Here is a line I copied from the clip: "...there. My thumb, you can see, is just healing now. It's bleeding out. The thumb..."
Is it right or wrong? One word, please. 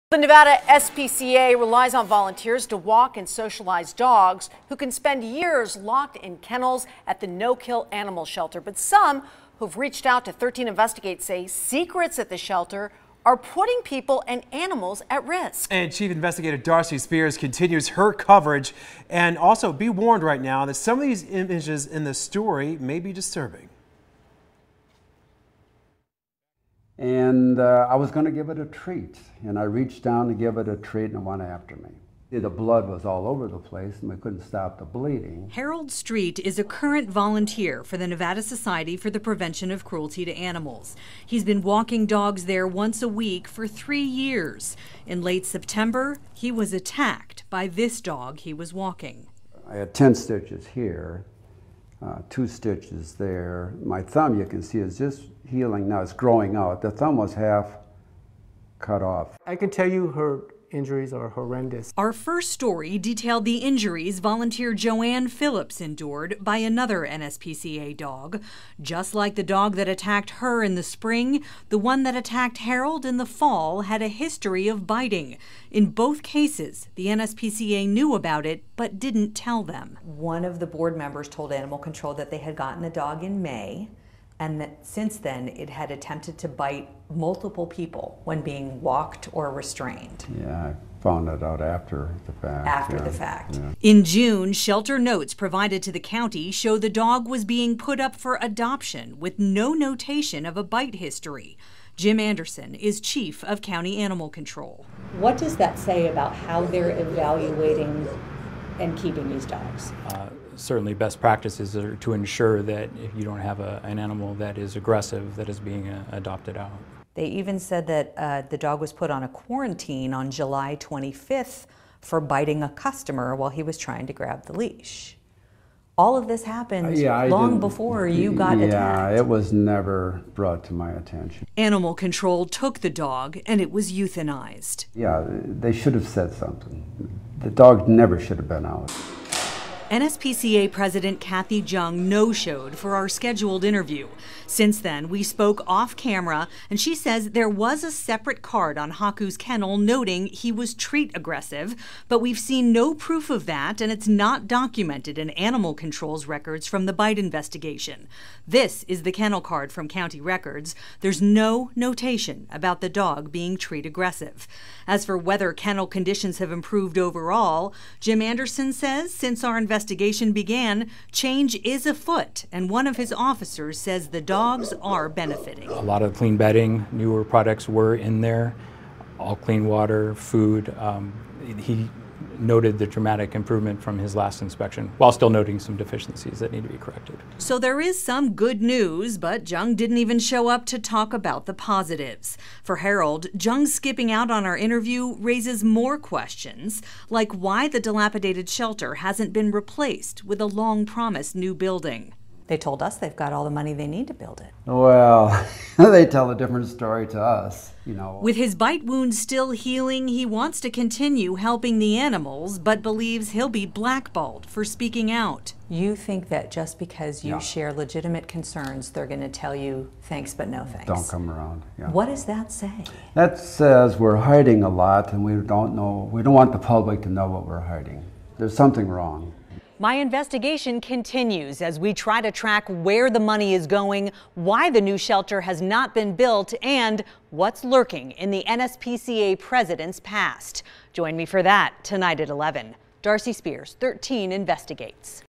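wrong.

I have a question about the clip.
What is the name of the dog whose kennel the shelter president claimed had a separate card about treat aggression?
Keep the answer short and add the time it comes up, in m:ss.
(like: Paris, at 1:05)
Haku, at 2:28.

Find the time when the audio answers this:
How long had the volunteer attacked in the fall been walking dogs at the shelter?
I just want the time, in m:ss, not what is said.
0:43.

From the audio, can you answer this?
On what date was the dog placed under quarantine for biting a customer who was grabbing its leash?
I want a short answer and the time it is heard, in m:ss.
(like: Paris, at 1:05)
July 25th, at 2:00.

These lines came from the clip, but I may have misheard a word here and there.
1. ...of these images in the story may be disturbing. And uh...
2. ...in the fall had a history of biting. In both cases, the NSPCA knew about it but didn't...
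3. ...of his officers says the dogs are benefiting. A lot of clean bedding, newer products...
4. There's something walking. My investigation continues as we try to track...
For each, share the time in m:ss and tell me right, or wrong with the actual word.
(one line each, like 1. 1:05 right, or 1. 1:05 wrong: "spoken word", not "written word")
1. 0:20 right
2. 1:13 right
3. 2:52 right
4. 3:48 wrong: "wrong", not "walking".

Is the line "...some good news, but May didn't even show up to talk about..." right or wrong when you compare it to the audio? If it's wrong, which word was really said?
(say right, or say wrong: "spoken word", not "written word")
wrong: "Jung", not "May".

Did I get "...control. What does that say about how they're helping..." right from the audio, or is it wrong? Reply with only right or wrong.
wrong.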